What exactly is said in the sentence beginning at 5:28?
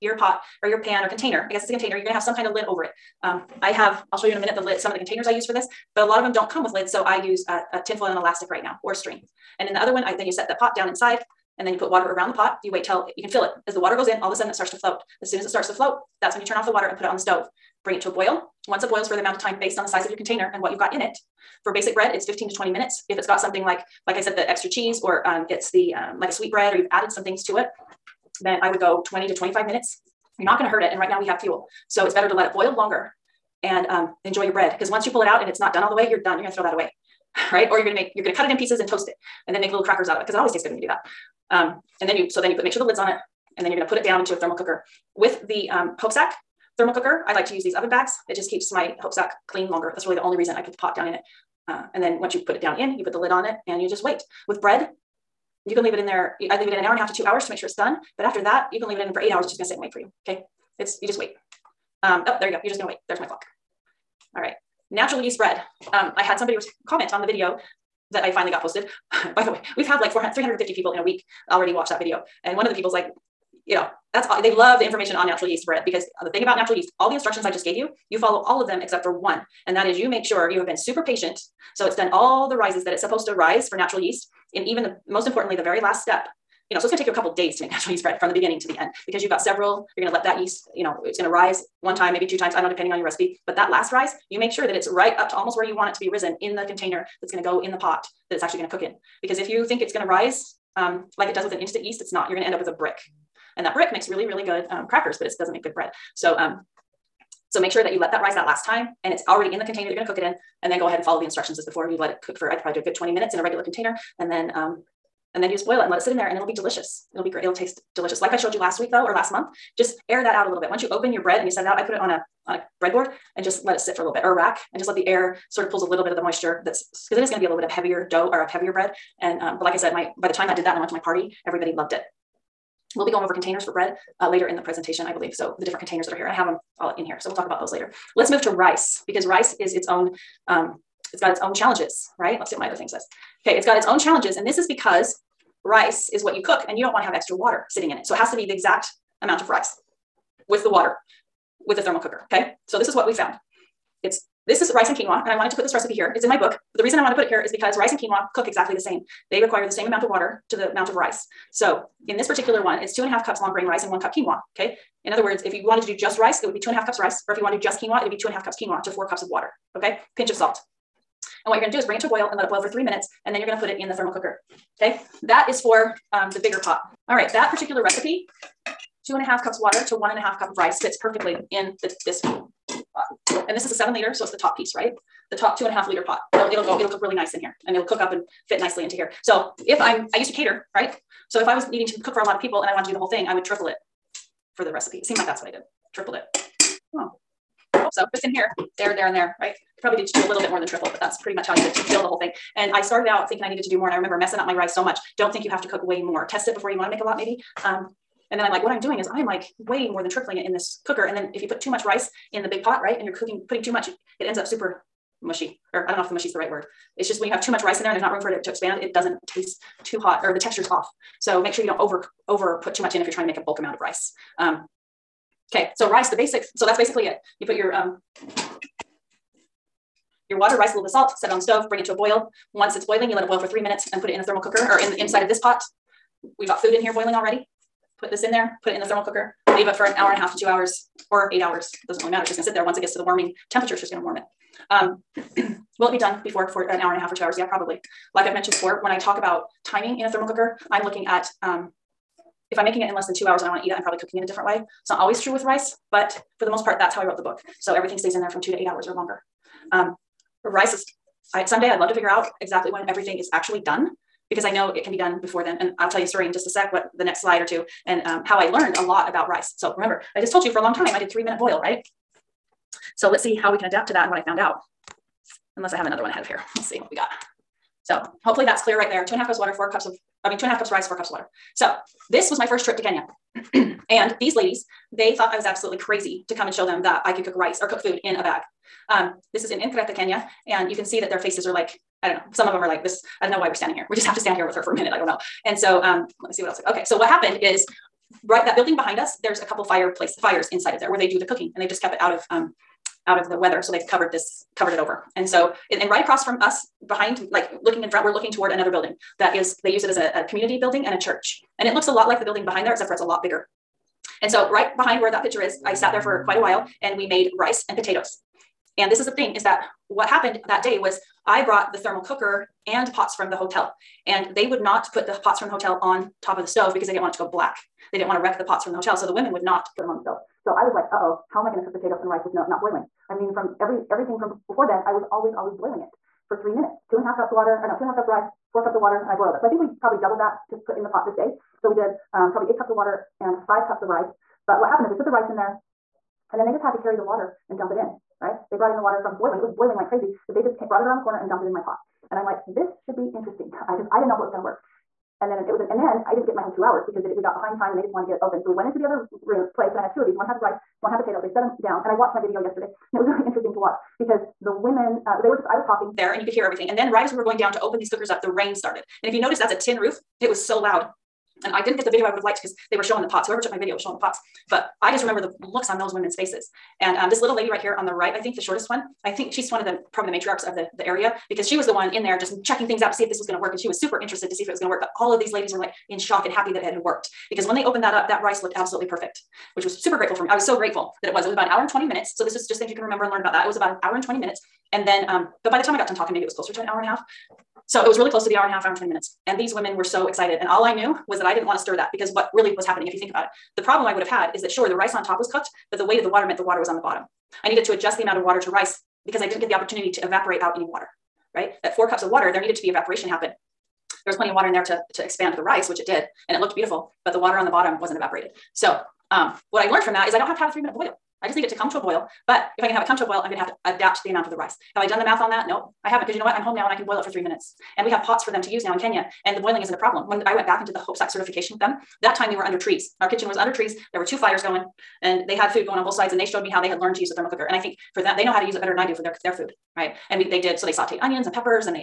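So the women would not put them on the stove.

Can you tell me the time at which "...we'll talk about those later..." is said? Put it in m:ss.
2:17.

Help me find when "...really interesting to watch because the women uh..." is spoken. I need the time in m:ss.
6:03.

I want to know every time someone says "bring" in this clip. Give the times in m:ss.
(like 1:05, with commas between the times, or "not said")
0:17, 2:51, 3:51.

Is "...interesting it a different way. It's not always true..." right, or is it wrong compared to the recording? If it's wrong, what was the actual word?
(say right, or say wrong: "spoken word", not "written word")
wrong: "cooking", not "interesting".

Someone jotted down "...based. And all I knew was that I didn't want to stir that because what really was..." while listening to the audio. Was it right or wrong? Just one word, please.
wrong.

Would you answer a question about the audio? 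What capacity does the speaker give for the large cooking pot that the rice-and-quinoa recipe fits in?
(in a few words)
7 liters.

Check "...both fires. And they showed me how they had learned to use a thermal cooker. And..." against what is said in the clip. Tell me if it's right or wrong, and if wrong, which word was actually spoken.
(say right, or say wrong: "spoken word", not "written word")
wrong: "sides", not "fires".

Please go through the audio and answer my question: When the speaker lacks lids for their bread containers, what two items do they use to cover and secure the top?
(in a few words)
tin foil and elastic.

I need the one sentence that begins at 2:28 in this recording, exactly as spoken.
So it has to be the exact amount of rice with the water with the thermal cooker.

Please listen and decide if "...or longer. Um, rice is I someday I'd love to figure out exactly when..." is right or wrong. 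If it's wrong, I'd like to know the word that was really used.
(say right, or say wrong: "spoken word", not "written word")
right.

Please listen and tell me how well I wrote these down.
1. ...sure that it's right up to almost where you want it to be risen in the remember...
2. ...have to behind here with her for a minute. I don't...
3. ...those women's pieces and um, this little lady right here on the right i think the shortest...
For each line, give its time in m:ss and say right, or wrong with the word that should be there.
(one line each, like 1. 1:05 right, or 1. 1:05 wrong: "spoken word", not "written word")
1. 1:34 wrong: "container", not "remember"
2. 4:54 wrong: "stand", not "behind"
3. 6:15 wrong: "faces", not "pieces".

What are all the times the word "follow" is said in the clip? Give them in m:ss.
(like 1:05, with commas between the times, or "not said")
1:18, 1:51.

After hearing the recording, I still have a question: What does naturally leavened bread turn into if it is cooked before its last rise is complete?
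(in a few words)
a brick.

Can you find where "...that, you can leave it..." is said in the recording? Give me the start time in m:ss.
0:58.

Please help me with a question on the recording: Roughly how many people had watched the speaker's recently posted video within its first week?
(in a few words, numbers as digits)
400.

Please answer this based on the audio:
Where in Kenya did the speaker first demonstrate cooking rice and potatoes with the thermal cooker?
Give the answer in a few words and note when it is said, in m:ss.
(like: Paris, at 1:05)
Nkreta, at 4:49.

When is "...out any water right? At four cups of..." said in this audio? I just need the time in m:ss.
6:50.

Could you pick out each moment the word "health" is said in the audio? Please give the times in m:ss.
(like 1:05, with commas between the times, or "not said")
not said.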